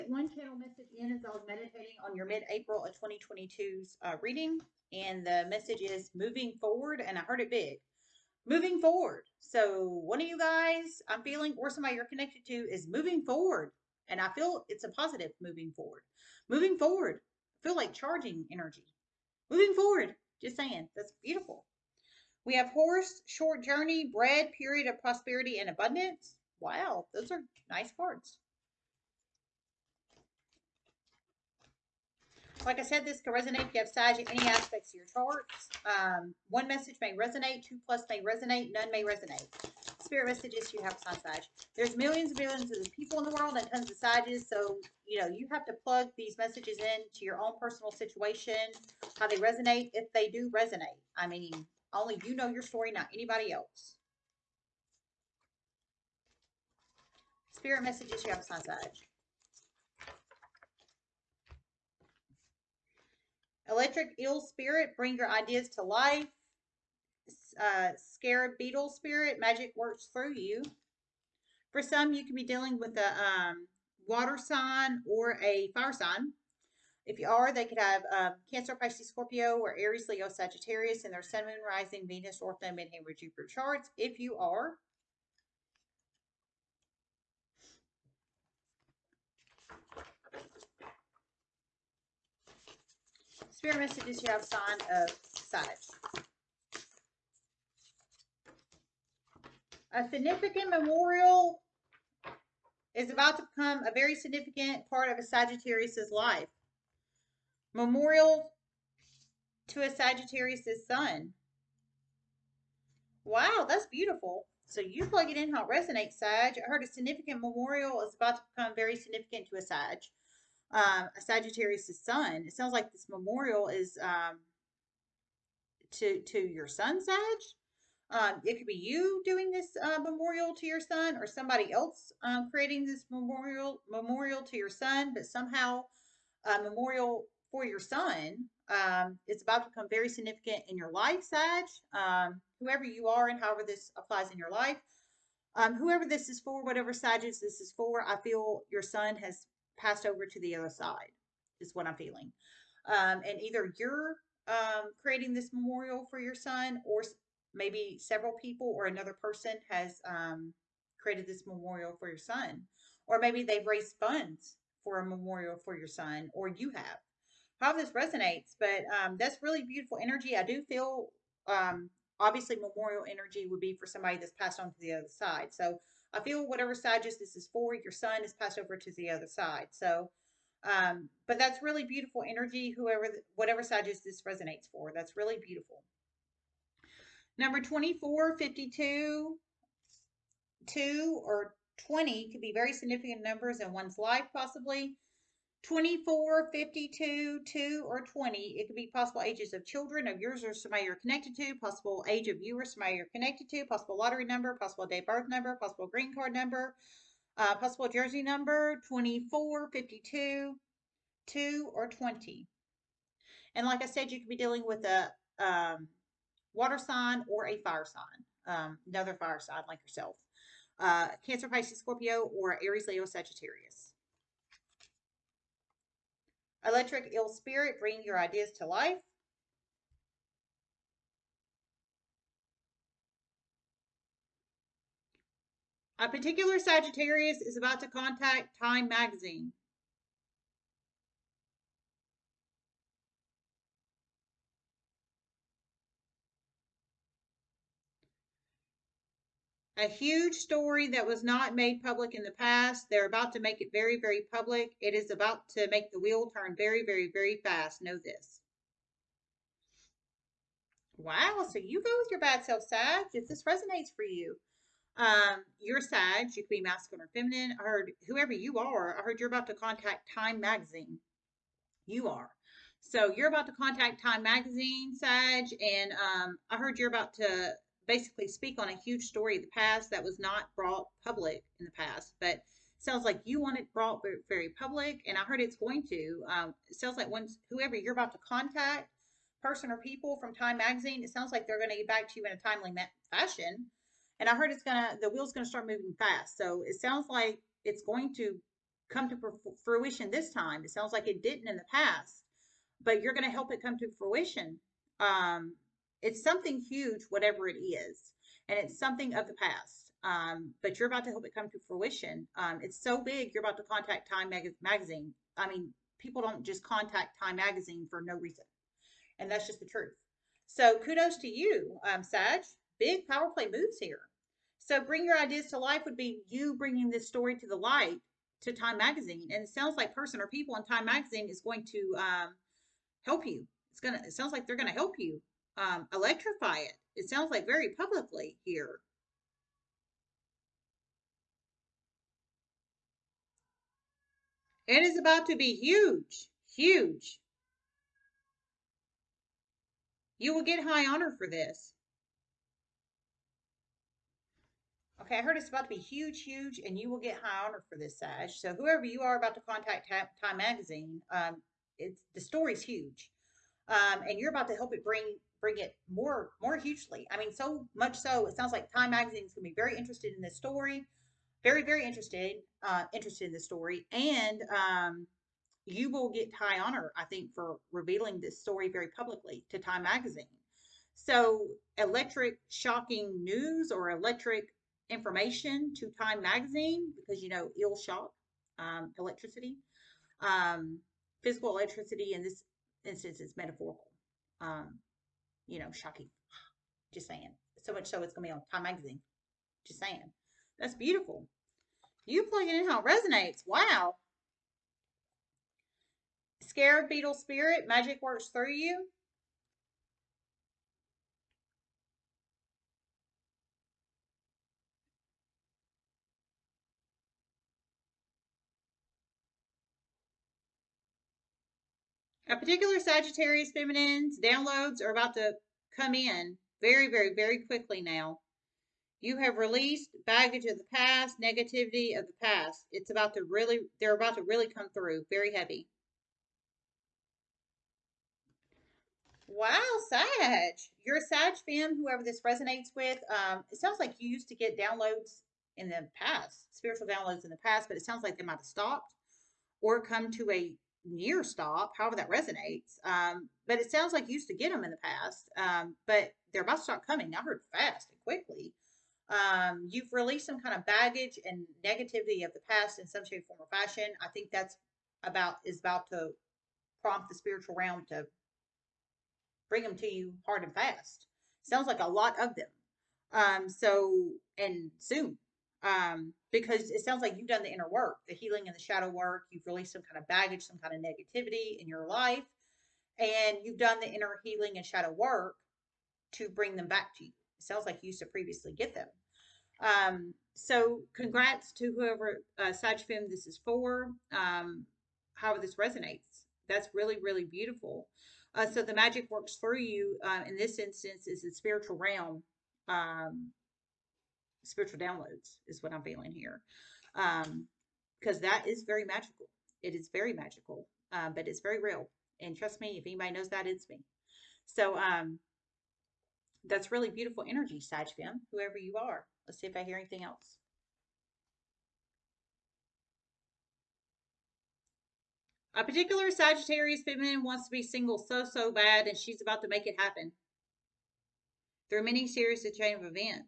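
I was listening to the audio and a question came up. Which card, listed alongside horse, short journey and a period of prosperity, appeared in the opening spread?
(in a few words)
Bread.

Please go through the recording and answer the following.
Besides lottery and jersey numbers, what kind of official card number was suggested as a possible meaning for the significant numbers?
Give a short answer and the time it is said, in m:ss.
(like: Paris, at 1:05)
Green card number, at 3:25.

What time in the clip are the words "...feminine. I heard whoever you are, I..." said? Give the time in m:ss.
4:27.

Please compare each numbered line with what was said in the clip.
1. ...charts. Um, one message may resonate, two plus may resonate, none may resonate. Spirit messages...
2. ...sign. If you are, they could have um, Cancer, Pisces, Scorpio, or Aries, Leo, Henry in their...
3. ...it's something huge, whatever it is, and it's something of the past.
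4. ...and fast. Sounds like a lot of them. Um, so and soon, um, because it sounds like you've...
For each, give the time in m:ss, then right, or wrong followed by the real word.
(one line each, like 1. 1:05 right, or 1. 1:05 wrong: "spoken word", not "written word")
1. 0:35 right
2. 1:15 wrong: "Sagittarius", not "Henry"
3. 5:06 right
4. 7:50 right.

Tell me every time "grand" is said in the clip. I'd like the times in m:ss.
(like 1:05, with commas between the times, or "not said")
not said.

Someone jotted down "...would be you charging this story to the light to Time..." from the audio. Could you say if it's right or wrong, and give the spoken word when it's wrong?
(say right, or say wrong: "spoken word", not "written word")
wrong: "bringing", not "charging".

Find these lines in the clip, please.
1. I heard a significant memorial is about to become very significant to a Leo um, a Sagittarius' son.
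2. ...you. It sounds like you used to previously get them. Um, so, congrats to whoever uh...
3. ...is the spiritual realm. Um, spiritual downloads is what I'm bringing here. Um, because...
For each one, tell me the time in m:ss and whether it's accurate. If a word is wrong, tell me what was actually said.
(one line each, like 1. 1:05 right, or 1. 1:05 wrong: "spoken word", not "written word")
1. 1:56 wrong: "Sag", not "Leo"
2. 8:07 right
3. 8:21 wrong: "feeling", not "bringing".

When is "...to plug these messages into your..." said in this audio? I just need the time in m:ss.
0:45.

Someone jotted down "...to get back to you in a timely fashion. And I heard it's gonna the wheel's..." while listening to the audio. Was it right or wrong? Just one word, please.
right.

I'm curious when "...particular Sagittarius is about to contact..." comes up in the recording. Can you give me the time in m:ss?
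3:56.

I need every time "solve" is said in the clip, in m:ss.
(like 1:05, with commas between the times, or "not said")
not said.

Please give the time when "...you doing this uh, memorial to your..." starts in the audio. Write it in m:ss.
2:08.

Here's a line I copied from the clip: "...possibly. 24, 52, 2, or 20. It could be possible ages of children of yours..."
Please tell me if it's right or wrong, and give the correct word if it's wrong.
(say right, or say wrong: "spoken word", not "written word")
right.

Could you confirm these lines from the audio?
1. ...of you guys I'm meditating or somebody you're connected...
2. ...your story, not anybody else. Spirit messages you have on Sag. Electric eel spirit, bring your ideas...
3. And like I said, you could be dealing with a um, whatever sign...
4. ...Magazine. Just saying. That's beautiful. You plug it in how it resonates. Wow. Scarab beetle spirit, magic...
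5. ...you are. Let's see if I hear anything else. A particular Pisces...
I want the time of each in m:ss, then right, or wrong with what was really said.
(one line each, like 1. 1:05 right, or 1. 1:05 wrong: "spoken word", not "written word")
1. 0:10 wrong: "feeling", not "meditating"
2. 0:52 right
3. 3:33 wrong: "water", not "whatever"
4. 6:38 right
5. 8:38 wrong: "Sagittarius", not "Pisces".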